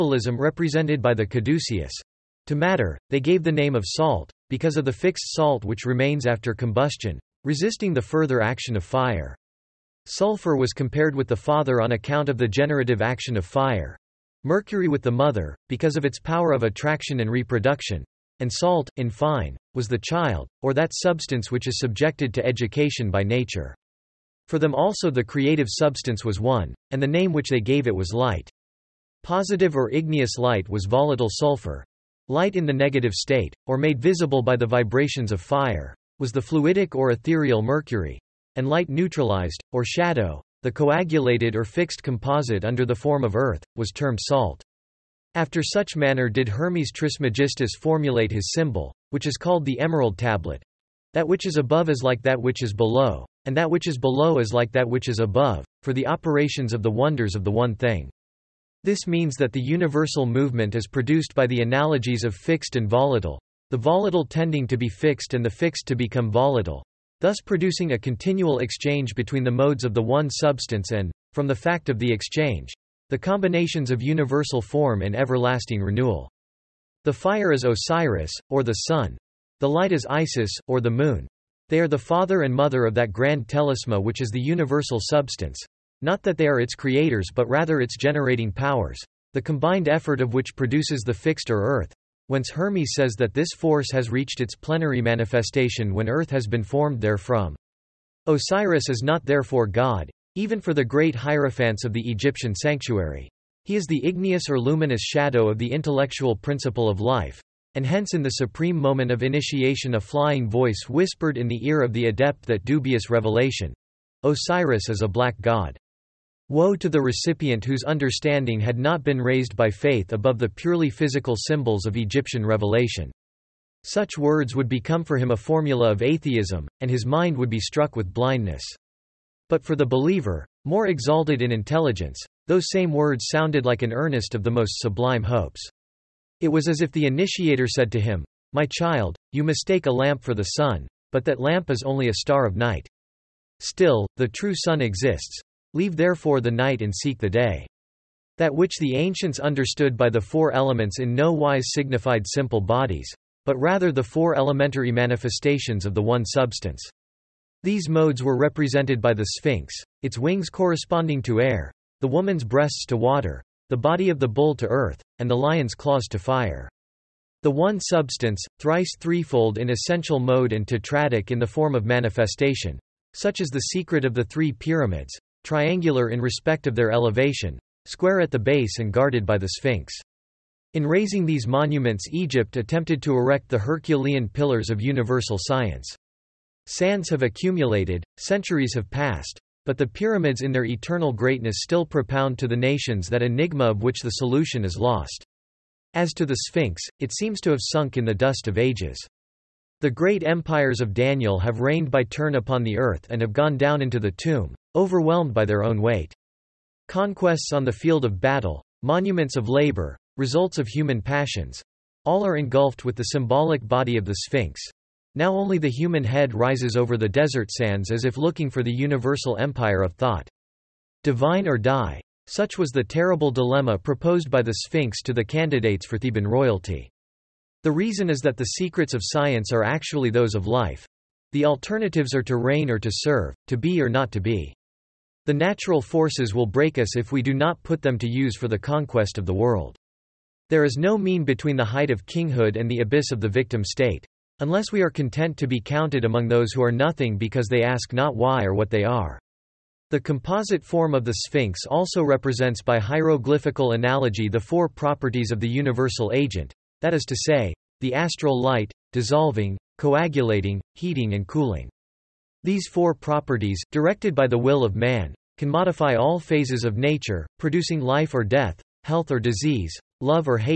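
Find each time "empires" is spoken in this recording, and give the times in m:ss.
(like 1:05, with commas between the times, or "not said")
3:20, 3:39.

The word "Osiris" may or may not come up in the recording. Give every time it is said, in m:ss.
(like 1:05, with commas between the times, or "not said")
1:17, 1:38, 1:54.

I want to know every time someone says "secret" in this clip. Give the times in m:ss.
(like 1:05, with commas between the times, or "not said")
2:53, 3:48.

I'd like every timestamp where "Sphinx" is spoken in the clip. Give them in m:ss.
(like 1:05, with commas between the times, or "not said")
2:39, 2:59, 3:16, 3:34, 3:44, 4:11.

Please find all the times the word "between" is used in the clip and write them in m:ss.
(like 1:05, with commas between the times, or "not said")
1:09, 4:01.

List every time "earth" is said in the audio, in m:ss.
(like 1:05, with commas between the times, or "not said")
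0:43, 1:31, 1:36, 2:44, 3:22.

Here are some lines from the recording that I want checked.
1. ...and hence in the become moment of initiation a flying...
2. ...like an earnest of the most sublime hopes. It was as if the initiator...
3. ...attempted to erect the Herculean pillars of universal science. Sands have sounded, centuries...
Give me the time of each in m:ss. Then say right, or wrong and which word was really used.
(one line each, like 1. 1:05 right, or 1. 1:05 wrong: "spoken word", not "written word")
1. 1:47 wrong: "supreme", not "become"
2. 2:13 right
3. 3:02 wrong: "accumulated", not "sounded".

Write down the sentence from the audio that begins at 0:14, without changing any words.
Mercury with the mother, because of its power of attraction and reproduction.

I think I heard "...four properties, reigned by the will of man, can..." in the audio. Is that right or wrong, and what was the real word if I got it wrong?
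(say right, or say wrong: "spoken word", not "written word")
wrong: "directed", not "reigned".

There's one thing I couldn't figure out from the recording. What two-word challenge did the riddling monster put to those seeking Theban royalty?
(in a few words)
Divine or die.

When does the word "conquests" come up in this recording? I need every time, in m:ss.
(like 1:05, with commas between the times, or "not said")
3:26, 3:58.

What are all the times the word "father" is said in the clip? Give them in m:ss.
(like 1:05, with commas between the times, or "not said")
0:11, 1:21.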